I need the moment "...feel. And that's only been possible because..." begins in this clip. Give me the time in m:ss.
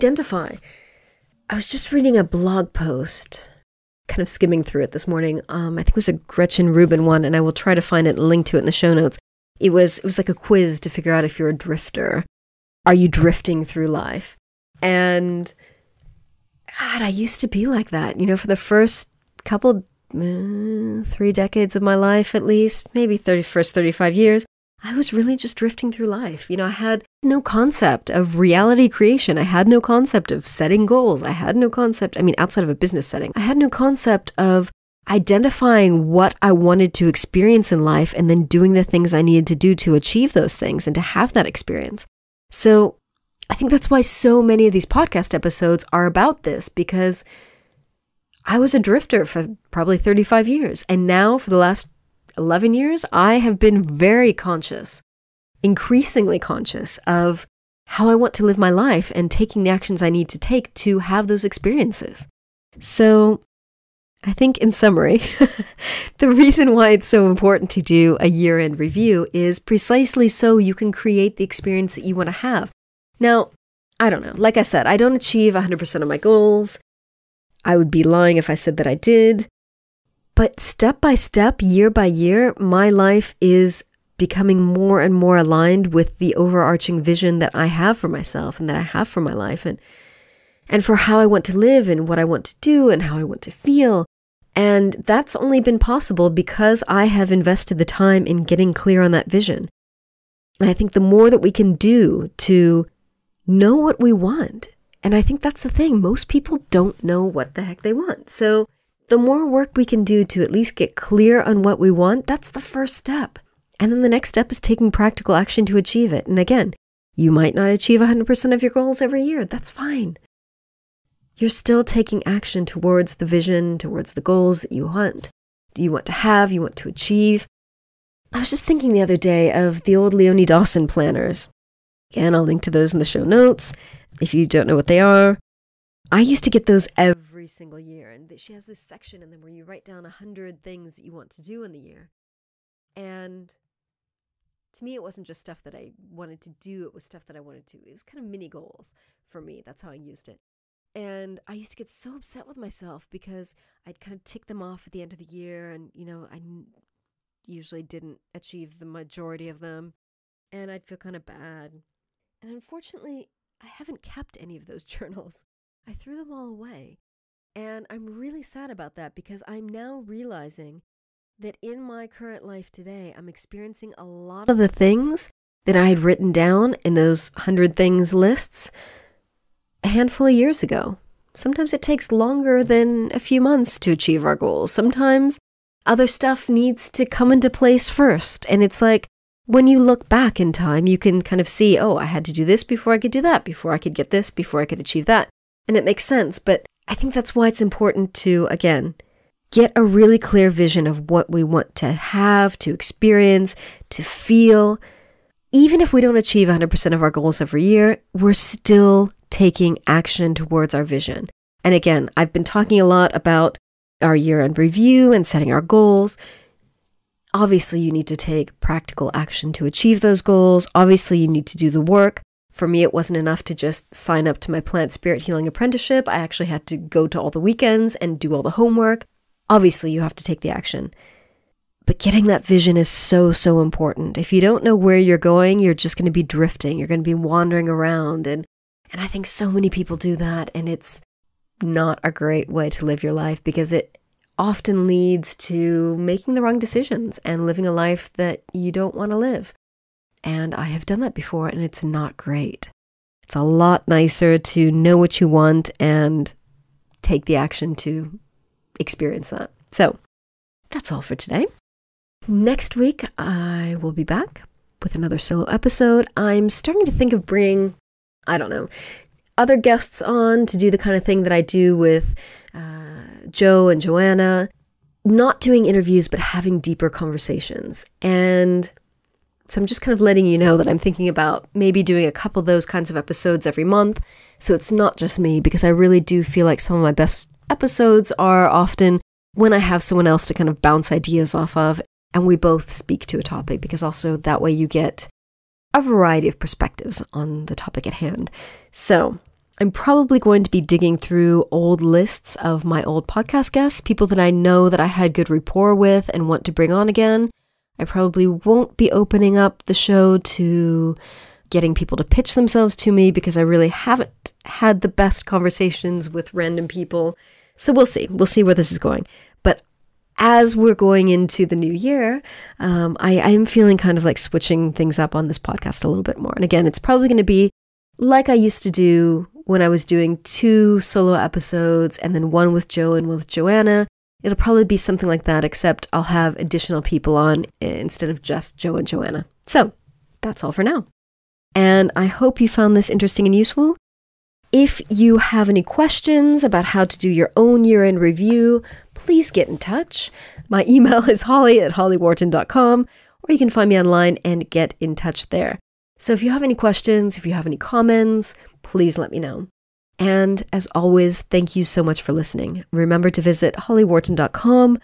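1:33.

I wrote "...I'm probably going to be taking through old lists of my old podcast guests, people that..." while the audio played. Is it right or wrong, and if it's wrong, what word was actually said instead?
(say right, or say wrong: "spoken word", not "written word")
wrong: "digging", not "taking".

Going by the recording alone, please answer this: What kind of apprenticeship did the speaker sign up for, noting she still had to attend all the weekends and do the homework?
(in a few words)
plant spirit healing.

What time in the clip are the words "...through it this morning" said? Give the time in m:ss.
0:04.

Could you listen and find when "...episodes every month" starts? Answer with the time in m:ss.
4:42.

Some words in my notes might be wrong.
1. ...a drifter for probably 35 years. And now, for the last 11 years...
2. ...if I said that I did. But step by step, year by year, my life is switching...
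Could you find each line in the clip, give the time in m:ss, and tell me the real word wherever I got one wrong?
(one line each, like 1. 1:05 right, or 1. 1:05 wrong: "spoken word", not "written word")
1. 0:48 right
2. 1:18 wrong: "becoming", not "switching".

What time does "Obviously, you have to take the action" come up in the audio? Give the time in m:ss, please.
3:49.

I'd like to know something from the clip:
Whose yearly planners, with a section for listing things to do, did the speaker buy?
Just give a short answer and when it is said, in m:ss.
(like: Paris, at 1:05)
Leonie Dawson, at 2:10.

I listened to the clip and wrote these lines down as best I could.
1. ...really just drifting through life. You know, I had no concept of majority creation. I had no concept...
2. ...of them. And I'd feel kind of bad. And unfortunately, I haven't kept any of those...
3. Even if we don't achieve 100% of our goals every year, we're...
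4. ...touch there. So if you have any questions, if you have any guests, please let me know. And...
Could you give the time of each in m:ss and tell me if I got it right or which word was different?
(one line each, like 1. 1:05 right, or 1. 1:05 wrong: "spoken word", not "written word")
1. 0:25 wrong: "reality", not "majority"
2. 2:39 right
3. 3:25 right
4. 5:54 wrong: "comments", not "guests".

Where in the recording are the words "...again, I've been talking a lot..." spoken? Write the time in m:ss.
3:31.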